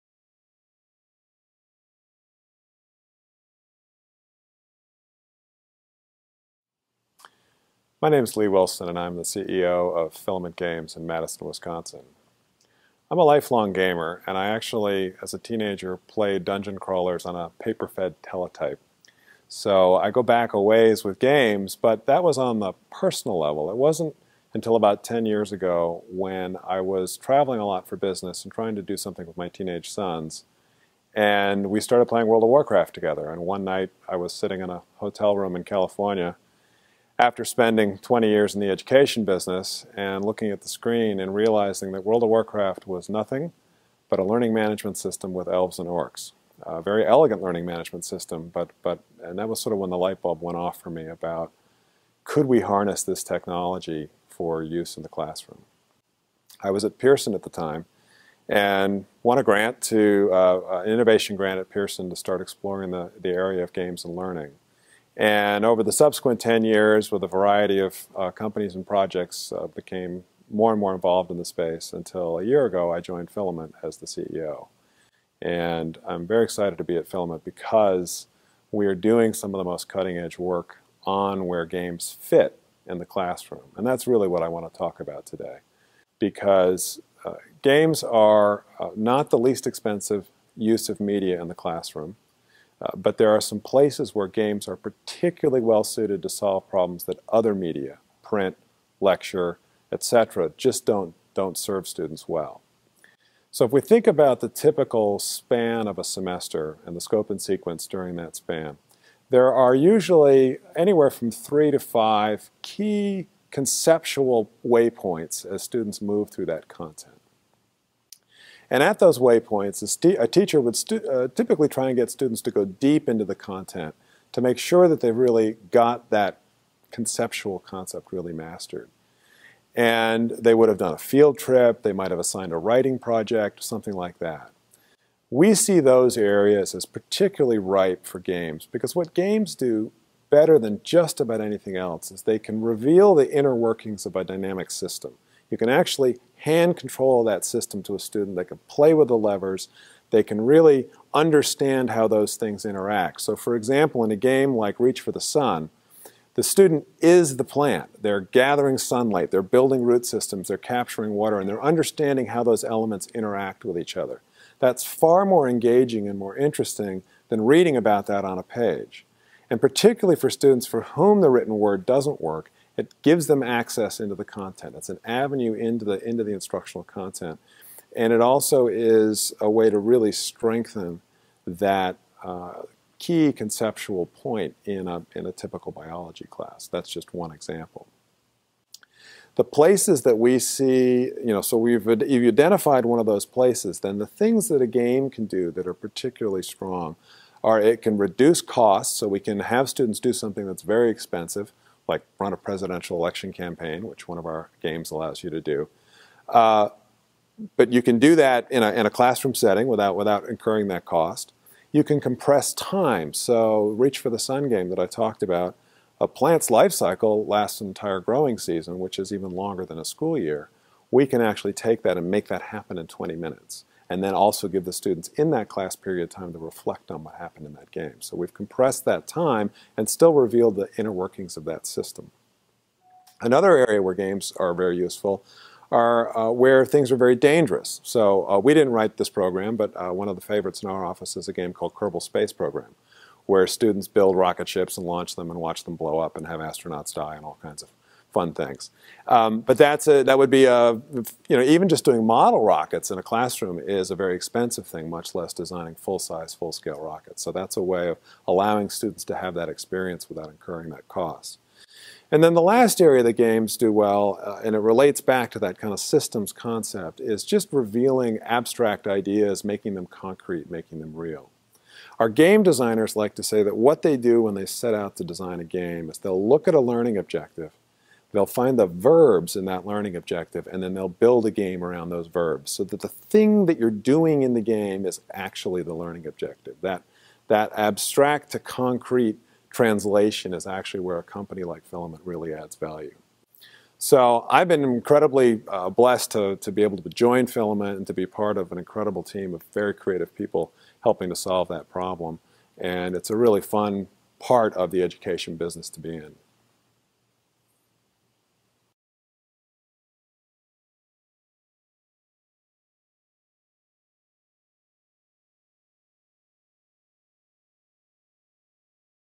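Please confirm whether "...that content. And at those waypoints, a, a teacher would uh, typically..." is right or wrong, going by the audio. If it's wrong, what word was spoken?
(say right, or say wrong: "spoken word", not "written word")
right.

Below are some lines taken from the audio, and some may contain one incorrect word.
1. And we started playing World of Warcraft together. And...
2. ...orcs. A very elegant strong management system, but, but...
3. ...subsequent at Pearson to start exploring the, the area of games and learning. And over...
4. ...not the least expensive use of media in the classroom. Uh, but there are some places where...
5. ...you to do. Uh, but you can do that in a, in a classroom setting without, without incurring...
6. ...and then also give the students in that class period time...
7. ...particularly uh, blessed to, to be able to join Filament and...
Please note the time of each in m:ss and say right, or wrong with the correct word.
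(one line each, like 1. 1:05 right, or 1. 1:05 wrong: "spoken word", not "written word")
1. 0:31 right
2. 0:45 wrong: "learning", not "strong"
3. 1:01 wrong: "grant", not "subsequent"
4. 1:28 right
5. 3:25 right
6. 3:43 right
7. 4:54 wrong: "incredibly", not "particularly".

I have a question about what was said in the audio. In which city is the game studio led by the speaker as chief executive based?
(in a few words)
Madison, Wisconsin.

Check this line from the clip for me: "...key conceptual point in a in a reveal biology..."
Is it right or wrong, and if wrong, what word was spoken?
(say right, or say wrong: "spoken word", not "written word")
wrong: "typical", not "reveal".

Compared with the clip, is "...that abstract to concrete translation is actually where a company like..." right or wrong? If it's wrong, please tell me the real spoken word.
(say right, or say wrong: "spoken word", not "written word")
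right.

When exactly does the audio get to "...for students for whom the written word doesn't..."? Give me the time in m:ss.
2:50.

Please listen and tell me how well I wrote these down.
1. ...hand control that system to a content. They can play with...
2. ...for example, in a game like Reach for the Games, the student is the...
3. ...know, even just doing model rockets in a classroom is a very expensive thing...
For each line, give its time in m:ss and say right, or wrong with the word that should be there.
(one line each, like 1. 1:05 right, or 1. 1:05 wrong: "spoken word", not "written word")
1. 2:26 wrong: "student", not "content"
2. 2:33 wrong: "Sun", not "Games"
3. 4:11 right.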